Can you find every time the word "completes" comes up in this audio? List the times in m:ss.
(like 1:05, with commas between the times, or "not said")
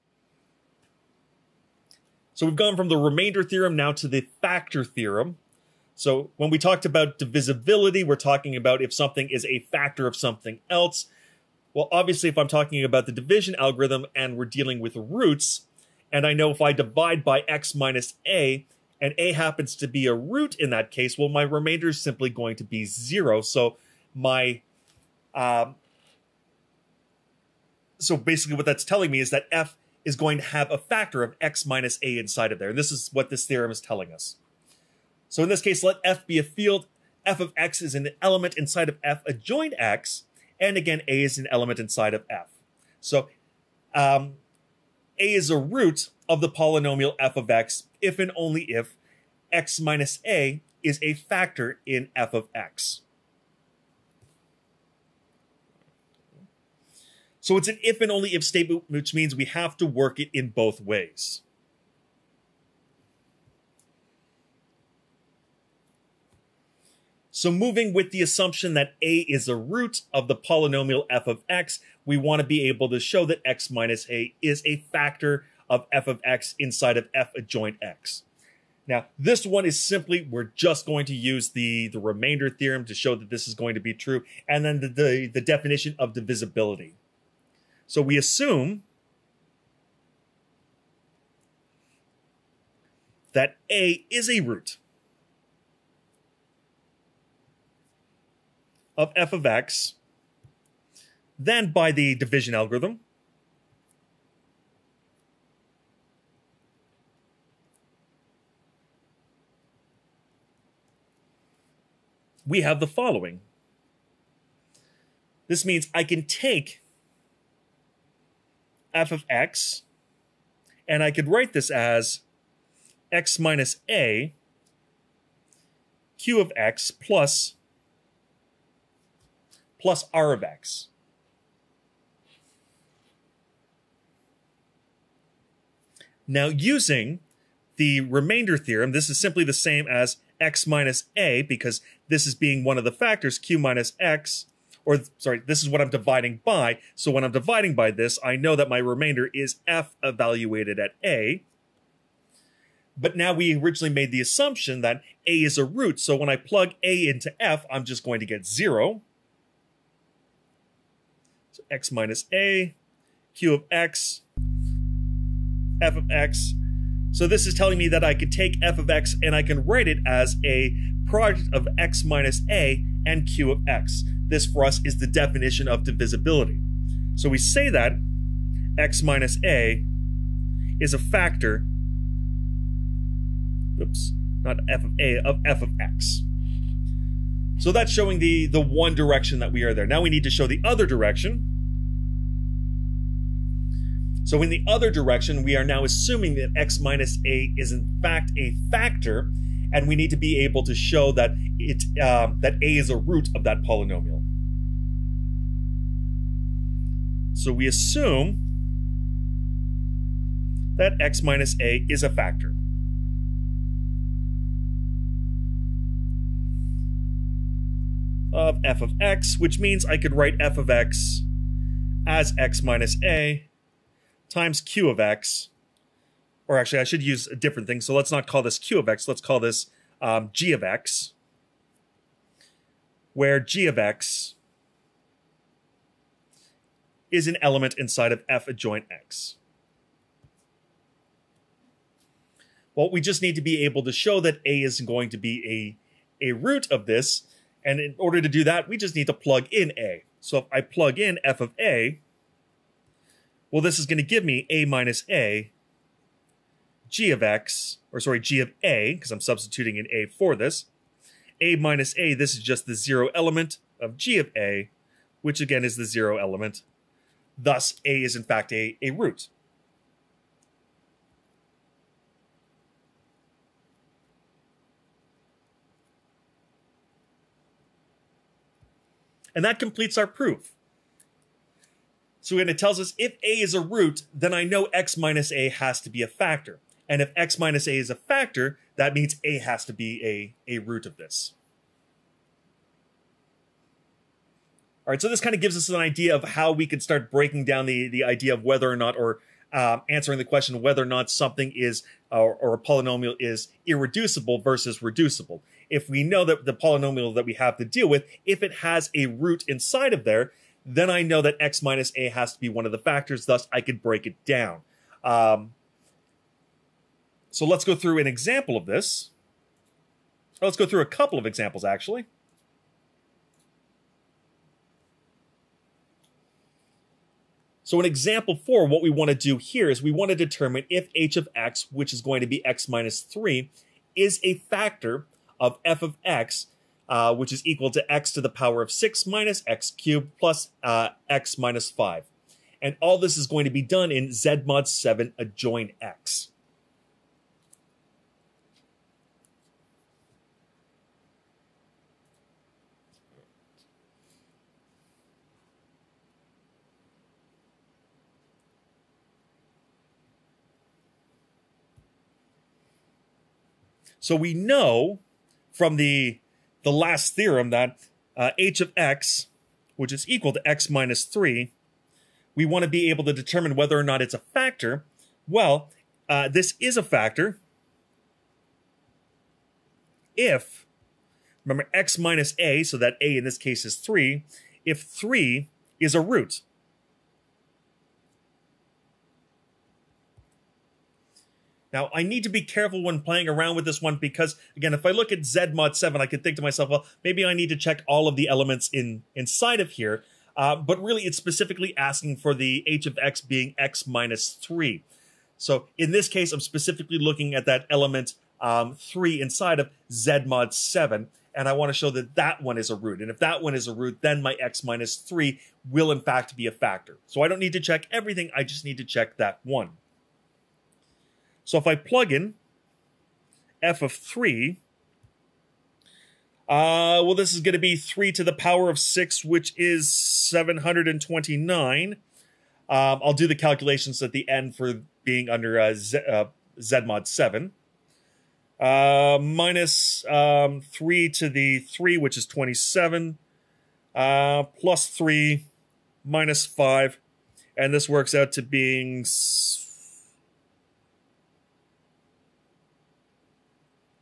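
4:39.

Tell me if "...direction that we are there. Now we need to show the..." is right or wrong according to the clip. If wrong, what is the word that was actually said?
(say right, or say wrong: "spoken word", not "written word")
right.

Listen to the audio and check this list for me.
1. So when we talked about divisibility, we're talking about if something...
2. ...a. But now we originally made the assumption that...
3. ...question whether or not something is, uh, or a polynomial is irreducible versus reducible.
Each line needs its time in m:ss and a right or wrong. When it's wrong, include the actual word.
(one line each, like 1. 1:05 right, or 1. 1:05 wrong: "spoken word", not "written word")
1. 0:05 right
2. 2:31 right
3. 5:00 right.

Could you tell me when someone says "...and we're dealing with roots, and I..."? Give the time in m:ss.
0:14.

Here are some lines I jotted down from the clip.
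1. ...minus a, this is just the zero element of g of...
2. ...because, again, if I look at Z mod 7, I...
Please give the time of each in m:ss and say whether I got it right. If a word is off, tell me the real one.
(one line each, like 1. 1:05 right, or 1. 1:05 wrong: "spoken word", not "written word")
1. 4:21 right
2. 6:33 right.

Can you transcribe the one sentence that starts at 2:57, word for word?
So we say that x minus a is a factor, oops, not f of a, of f of x.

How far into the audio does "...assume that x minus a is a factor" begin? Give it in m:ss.
3:27.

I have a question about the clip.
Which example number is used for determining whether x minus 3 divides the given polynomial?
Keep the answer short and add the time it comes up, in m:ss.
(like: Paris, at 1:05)
4, at 5:27.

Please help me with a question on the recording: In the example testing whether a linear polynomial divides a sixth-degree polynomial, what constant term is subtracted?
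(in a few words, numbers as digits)
5.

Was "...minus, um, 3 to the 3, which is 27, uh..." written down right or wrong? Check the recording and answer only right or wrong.
right.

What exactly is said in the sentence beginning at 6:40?
Uh, but really, it's specifically asking for the h of x being x minus 3.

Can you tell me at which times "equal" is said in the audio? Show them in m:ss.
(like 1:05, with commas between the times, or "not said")
5:37, 6:10.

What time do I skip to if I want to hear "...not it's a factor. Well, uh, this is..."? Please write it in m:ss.
6:13.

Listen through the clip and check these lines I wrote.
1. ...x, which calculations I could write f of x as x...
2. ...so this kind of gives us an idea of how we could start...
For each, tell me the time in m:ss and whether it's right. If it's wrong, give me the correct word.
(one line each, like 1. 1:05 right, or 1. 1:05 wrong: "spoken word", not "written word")
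1. 3:38 wrong: "means", not "calculations"
2. 4:54 right.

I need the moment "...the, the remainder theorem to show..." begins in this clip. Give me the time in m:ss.
1:21.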